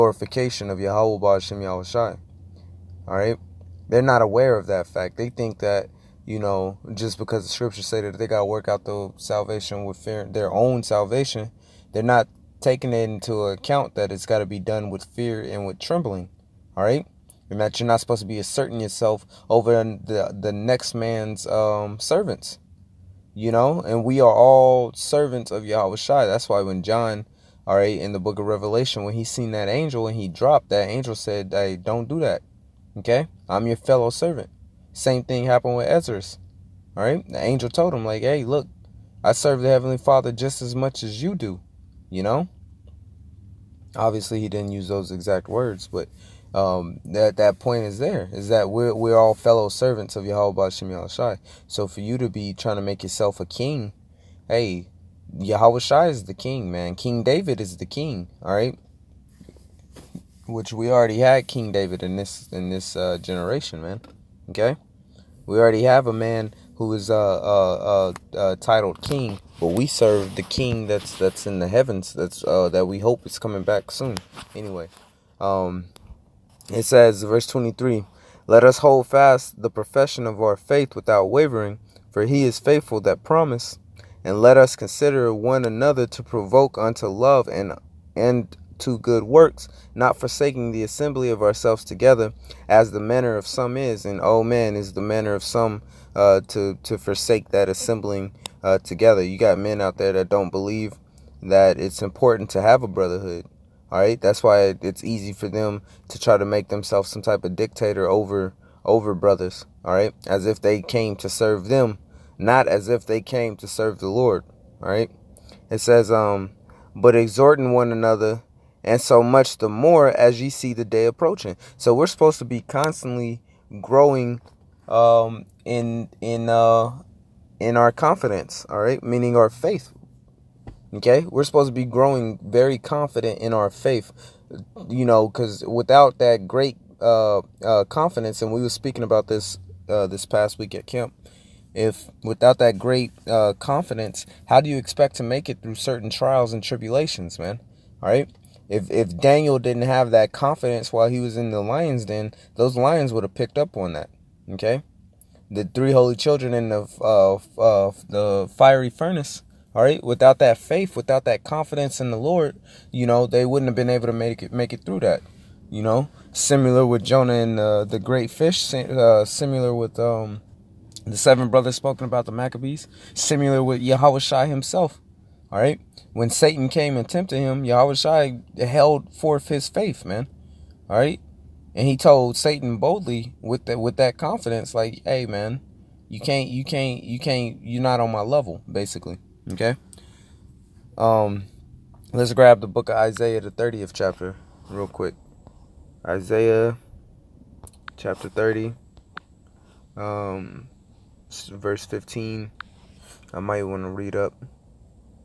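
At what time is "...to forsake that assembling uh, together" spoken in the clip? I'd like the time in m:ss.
1:36.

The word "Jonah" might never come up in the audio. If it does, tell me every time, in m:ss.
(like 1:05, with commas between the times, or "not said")
2:47.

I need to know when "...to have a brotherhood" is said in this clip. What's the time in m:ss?
1:42.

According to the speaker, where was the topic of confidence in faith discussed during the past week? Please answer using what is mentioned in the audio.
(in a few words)
At camp.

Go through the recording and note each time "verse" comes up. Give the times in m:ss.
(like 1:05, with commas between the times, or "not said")
1:17, 3:21.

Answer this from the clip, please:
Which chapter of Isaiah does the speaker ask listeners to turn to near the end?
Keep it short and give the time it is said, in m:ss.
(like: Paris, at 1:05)
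30, at 3:13.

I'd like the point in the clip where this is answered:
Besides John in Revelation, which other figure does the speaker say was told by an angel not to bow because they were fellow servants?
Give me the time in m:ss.
0:35.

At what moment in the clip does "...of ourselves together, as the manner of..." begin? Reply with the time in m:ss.
1:31.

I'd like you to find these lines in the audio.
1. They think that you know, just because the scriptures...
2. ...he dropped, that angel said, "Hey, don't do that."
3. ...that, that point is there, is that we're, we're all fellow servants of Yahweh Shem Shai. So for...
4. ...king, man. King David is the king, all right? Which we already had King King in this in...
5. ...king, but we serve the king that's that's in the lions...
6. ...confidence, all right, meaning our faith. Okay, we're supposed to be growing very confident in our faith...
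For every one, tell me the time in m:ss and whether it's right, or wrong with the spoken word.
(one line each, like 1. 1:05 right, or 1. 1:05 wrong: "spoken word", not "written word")
1. 0:05 right
2. 0:30 right
3. 0:47 right
4. 0:56 wrong: "David", not "King"
5. 1:09 wrong: "heavens", not "lions"
6. 2:07 right.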